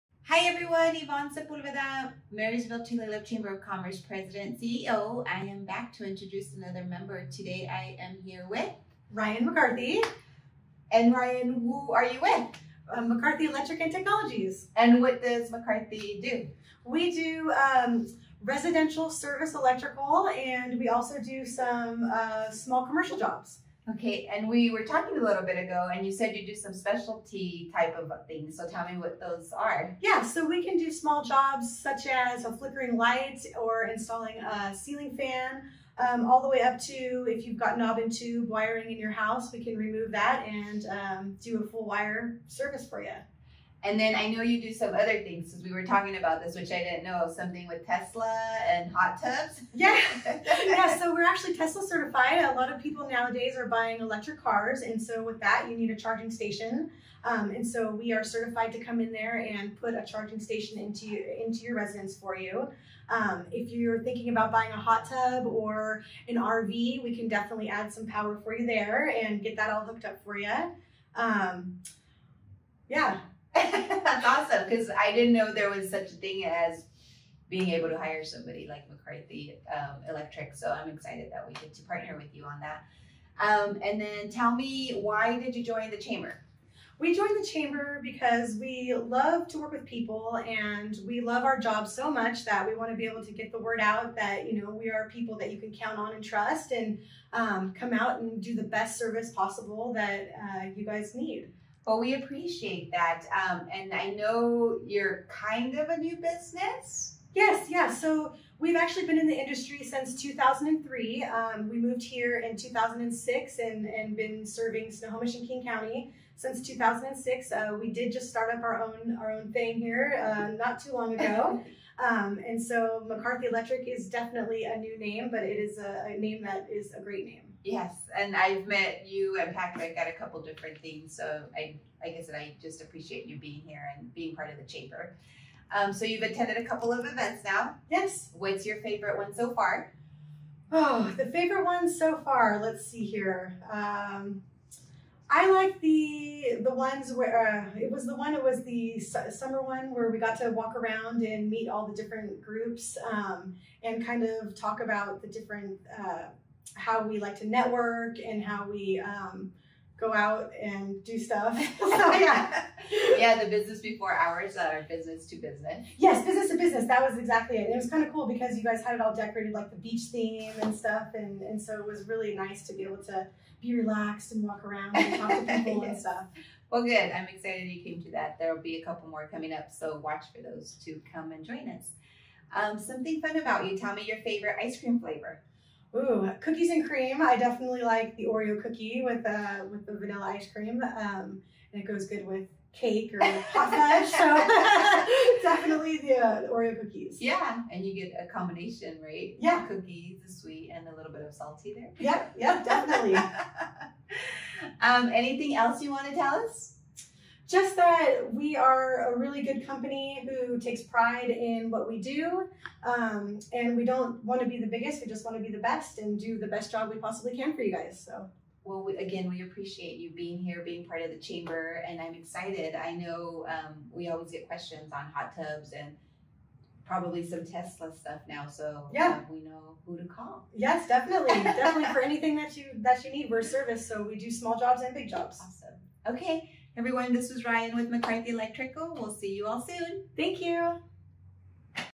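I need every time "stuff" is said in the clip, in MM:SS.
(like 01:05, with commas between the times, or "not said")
02:41, 02:50, 02:55, 03:47.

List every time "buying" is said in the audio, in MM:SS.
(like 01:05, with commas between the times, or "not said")
00:53, 01:04.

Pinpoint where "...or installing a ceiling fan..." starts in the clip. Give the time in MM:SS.
00:33.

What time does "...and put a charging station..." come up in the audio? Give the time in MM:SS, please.
00:59.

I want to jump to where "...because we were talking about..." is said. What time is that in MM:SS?
00:45.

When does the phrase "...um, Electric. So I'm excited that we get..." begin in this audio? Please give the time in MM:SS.
01:19.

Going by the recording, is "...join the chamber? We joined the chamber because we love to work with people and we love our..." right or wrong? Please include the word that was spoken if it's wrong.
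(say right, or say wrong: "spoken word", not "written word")
right.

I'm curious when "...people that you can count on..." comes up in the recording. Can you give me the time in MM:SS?
01:35.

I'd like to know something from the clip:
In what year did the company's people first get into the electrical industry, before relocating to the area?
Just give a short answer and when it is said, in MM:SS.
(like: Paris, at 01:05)
2003, at 01:50.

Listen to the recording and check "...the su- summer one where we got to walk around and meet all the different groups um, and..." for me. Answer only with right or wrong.
right.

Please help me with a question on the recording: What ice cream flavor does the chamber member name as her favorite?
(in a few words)
Cookies and cream.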